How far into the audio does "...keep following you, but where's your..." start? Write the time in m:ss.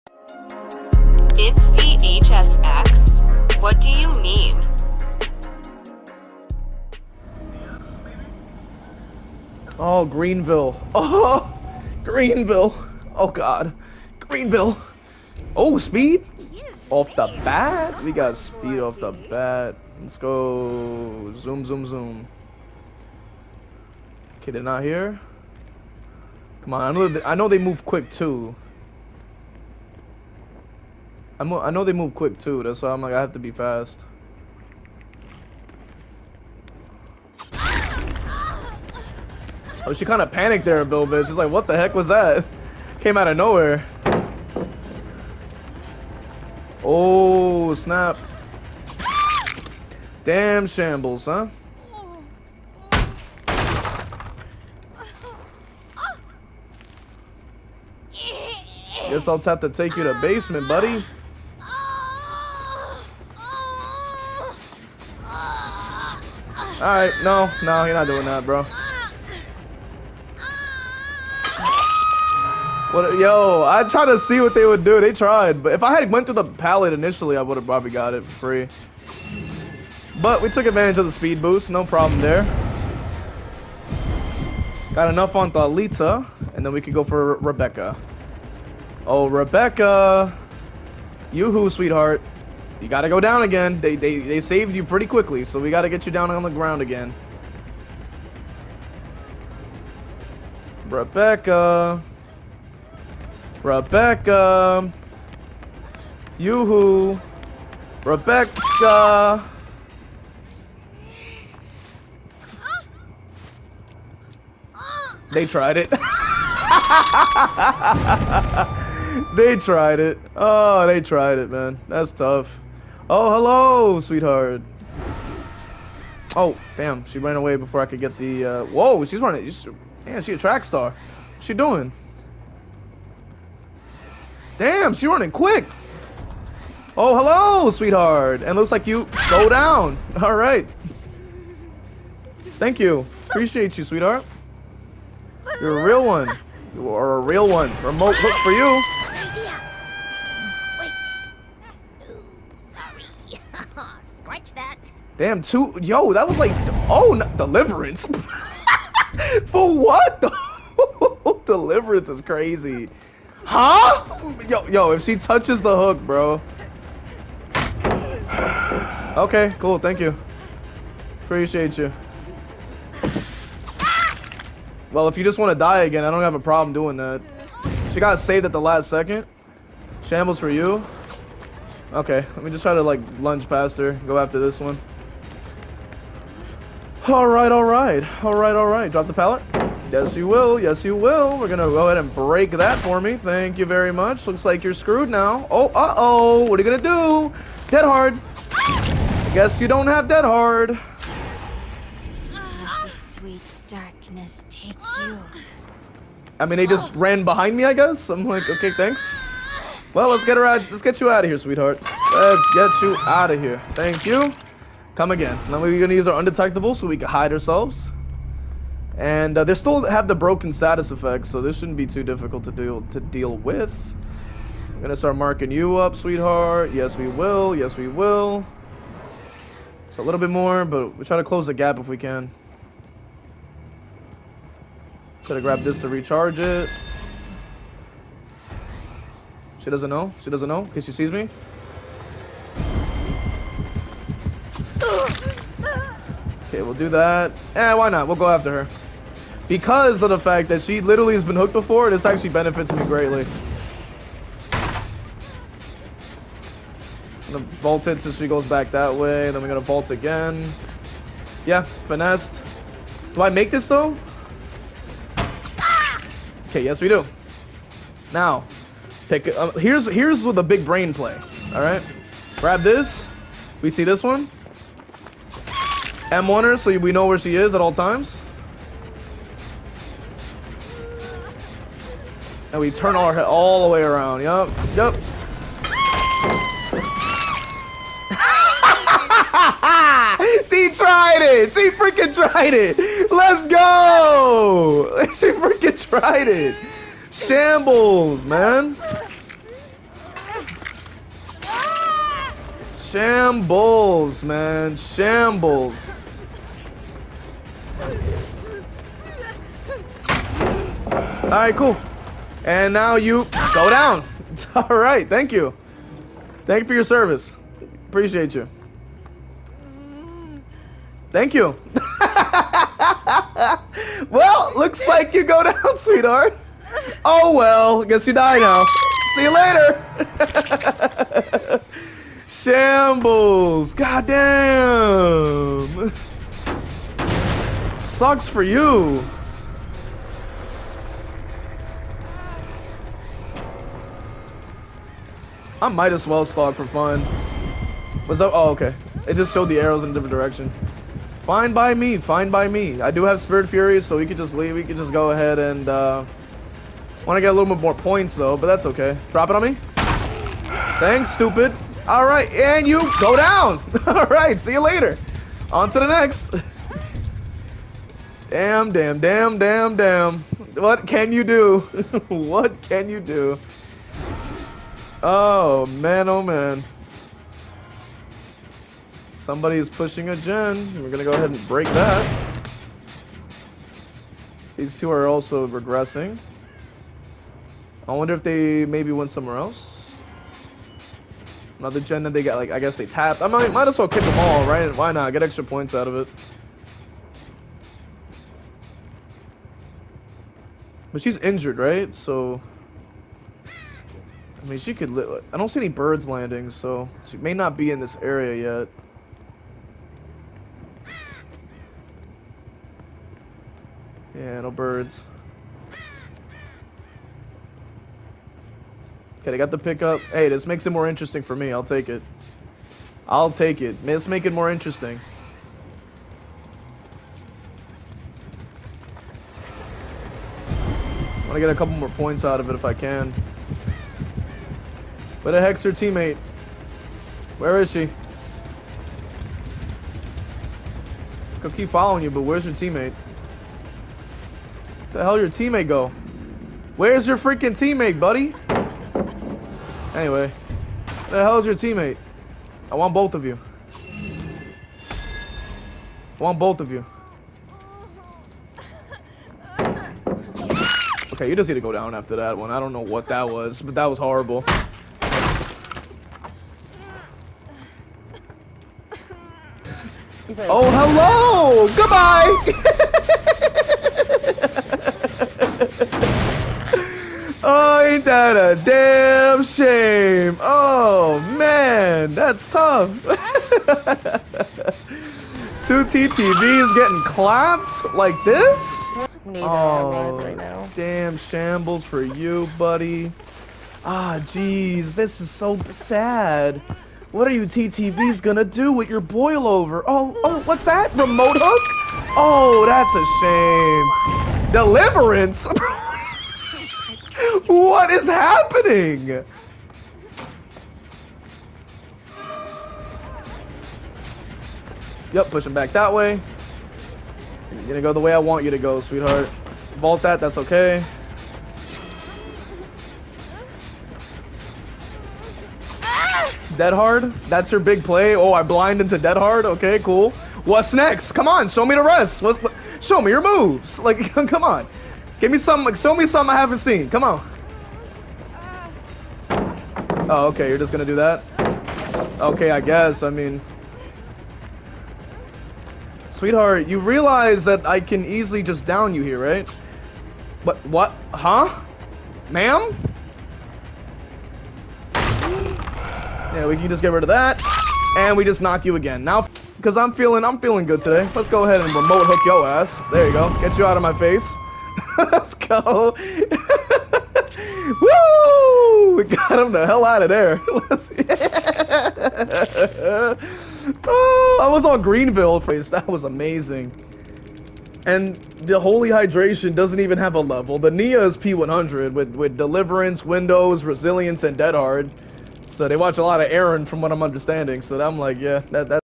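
7:21.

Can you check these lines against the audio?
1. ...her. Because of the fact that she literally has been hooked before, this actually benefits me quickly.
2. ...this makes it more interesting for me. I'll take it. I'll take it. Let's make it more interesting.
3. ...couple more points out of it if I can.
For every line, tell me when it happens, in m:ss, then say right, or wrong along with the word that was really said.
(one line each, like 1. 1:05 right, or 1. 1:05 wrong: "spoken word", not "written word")
1. 4:08 wrong: "greatly", not "quickly"
2. 7:00 right
3. 7:11 right.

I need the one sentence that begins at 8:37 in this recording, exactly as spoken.
You're gonna go the way I want you to go, sweetheart.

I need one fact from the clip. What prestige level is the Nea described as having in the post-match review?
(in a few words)
P100.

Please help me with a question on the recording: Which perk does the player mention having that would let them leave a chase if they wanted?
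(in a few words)
Spirit Fury.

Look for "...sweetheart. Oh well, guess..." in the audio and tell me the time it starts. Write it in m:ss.
5:25.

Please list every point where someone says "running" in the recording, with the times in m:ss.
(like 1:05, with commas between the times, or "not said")
2:09, 2:15.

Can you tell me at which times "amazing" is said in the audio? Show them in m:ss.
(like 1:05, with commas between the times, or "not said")
9:36.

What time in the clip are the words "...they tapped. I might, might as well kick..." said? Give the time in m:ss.
6:32.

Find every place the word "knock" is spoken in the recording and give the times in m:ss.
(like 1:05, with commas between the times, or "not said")
9:18.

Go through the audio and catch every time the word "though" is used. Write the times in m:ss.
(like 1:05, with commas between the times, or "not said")
4:23, 5:58.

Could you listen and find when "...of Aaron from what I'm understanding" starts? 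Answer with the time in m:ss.
9:46.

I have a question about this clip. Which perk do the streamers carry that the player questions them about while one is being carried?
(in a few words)
Boil Over.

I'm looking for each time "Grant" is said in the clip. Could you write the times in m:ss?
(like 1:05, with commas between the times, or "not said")
not said.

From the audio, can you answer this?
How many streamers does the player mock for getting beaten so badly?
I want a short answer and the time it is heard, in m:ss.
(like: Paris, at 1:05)
2, at 8:05.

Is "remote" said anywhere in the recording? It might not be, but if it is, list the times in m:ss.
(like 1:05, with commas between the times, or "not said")
2:27, 8:20, 9:21.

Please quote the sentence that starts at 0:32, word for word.
That's why I'm like I have to be fast.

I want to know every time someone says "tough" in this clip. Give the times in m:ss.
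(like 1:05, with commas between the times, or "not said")
2:02, 8:02.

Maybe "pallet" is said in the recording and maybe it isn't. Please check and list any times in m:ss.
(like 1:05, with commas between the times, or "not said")
1:16, 3:09.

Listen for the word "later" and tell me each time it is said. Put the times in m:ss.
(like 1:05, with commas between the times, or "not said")
5:29, 6:04.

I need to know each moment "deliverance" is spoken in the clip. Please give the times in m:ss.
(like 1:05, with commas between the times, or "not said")
2:37, 2:41, 8:24, 9:42.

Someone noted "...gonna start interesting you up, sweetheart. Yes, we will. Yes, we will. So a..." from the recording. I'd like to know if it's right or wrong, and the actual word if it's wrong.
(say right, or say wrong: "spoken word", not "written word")
wrong: "marking", not "interesting".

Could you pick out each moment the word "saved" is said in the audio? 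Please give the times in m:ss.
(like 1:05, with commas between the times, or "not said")
1:34, 2:58.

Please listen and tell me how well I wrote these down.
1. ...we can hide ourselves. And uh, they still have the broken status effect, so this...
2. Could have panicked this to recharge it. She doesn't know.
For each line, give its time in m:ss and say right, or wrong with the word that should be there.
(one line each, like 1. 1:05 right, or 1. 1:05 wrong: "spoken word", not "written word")
1. 3:36 right
2. 3:55 wrong: "grabbed", not "panicked".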